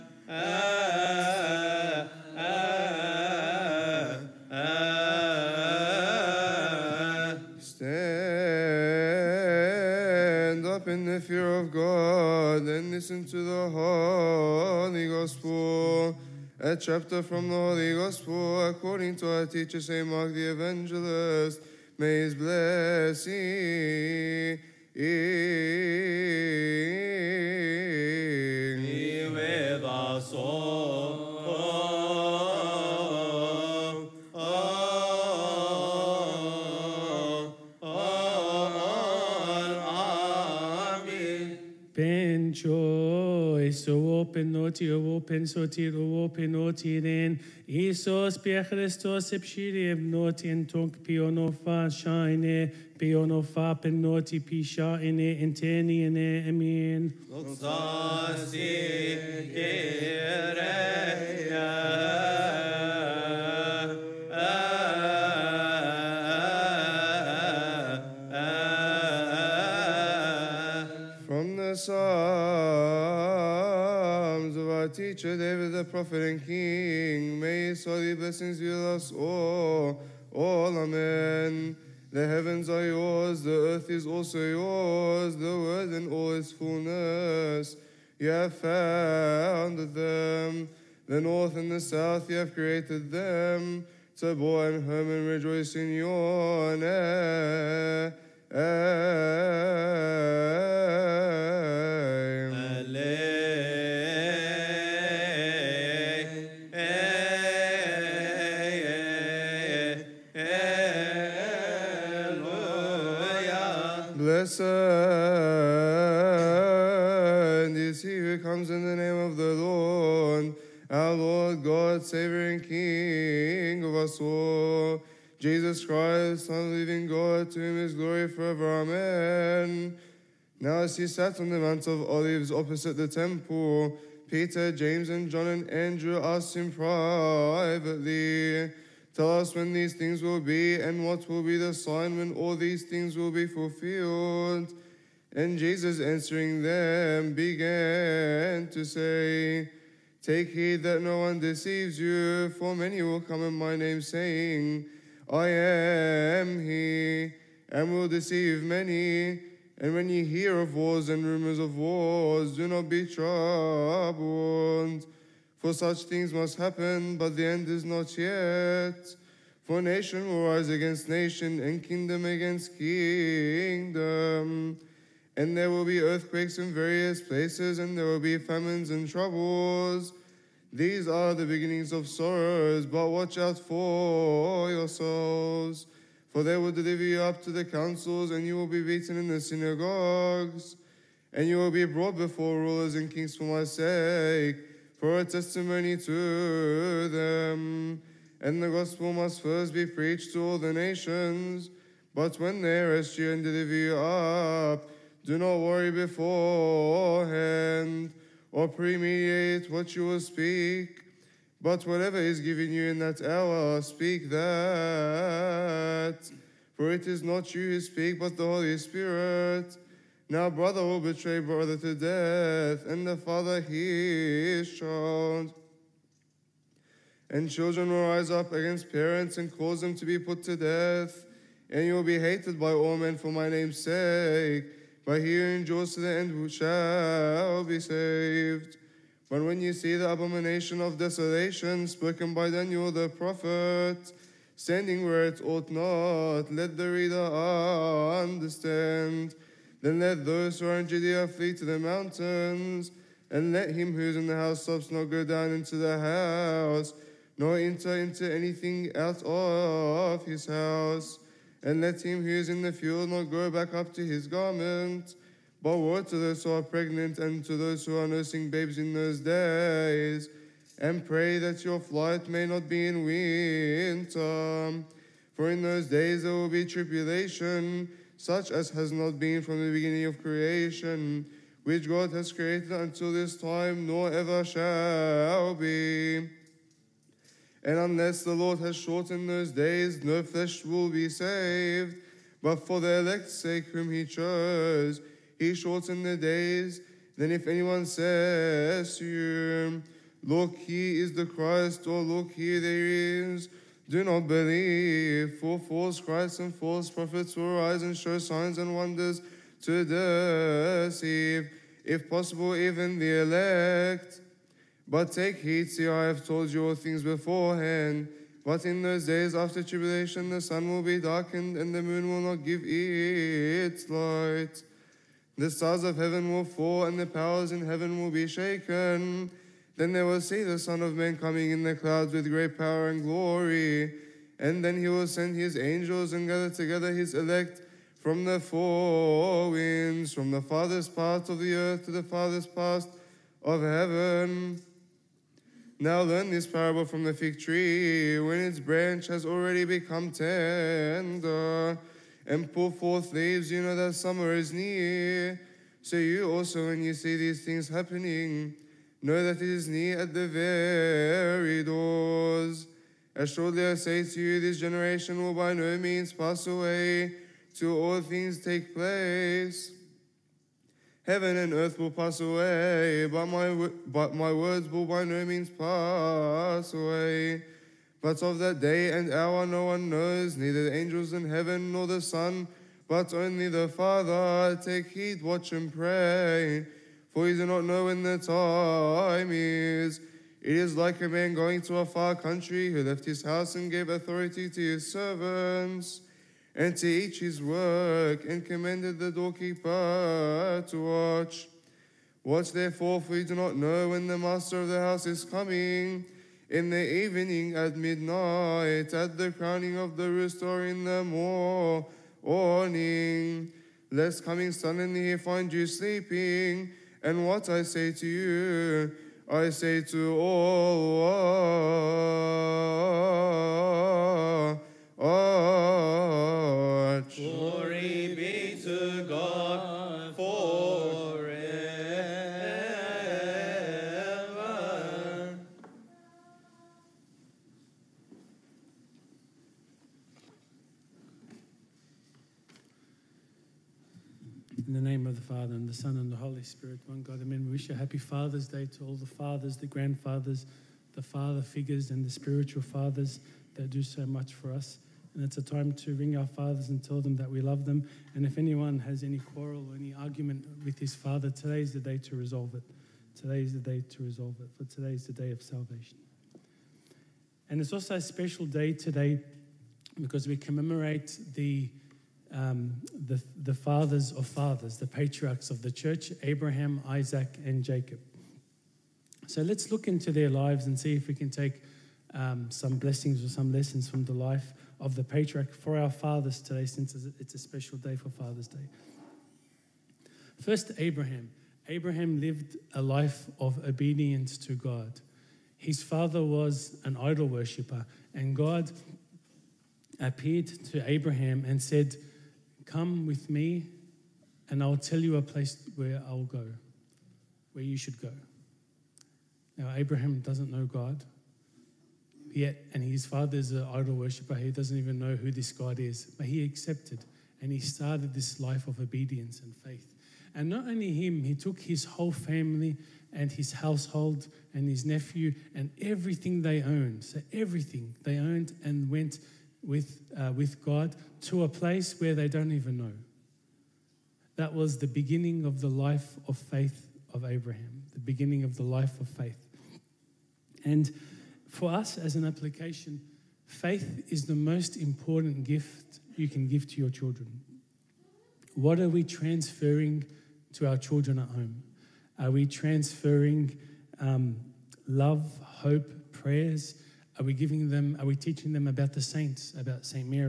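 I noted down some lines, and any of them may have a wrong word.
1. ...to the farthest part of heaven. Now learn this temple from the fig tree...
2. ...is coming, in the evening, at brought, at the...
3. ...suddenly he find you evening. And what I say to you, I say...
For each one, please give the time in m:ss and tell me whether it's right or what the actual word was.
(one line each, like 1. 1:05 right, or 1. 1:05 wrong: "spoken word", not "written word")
1. 5:41 wrong: "parable", not "temple"
2. 6:45 wrong: "midnight", not "brought"
3. 6:54 wrong: "sleeping", not "evening".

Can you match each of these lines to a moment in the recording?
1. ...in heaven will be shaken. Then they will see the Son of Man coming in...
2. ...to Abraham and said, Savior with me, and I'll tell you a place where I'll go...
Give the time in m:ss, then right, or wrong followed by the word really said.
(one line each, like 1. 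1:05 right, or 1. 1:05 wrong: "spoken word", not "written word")
1. 5:27 right
2. 8:20 wrong: "Come", not "Savior".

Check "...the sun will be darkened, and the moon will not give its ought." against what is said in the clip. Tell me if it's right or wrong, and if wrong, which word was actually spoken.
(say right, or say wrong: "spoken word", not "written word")
wrong: "light", not "ought".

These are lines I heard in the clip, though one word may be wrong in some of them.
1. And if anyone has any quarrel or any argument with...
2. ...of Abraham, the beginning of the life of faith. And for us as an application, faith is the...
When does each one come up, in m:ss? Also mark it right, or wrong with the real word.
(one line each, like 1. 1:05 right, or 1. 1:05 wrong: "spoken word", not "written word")
1. 7:38 right
2. 8:57 right.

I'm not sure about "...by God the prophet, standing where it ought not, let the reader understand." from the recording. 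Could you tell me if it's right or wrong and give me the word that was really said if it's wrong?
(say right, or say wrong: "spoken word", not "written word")
wrong: "Daniel", not "God".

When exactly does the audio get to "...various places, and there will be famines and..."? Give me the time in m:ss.
2:56.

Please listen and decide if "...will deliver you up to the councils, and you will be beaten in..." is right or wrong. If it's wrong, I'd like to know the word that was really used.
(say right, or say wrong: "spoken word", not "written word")
right.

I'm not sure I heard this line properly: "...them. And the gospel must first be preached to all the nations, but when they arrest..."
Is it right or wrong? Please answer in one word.
right.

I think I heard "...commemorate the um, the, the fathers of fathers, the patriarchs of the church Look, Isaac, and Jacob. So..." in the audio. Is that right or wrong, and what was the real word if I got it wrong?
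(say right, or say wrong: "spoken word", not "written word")
wrong: "Abraham", not "Look".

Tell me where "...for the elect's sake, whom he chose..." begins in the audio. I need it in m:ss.
4:52.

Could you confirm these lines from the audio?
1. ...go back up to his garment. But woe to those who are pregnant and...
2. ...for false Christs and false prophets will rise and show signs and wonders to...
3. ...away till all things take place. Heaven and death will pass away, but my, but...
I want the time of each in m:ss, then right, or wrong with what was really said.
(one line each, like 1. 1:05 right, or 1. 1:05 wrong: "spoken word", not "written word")
1. 4:23 right
2. 5:05 right
3. 6:06 wrong: "earth", not "death".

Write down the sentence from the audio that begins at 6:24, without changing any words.
Take heed, watch and pray, for you do not know when the time is.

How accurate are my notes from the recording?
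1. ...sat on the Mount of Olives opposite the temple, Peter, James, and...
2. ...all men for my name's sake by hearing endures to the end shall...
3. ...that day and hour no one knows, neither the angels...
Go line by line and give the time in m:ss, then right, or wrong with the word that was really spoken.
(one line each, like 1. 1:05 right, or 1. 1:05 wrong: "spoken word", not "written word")
1. 2:11 right
2. 3:52 right
3. 6:18 right.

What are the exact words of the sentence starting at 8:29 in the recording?
Now, Abraham doesn't know God yet, and his father is an idol worshiper.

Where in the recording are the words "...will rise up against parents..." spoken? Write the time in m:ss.
3:47.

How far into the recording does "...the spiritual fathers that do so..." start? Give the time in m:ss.
7:32.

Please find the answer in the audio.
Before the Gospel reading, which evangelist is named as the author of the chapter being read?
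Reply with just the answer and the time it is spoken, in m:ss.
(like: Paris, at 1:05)
St. Mark, at 0:19.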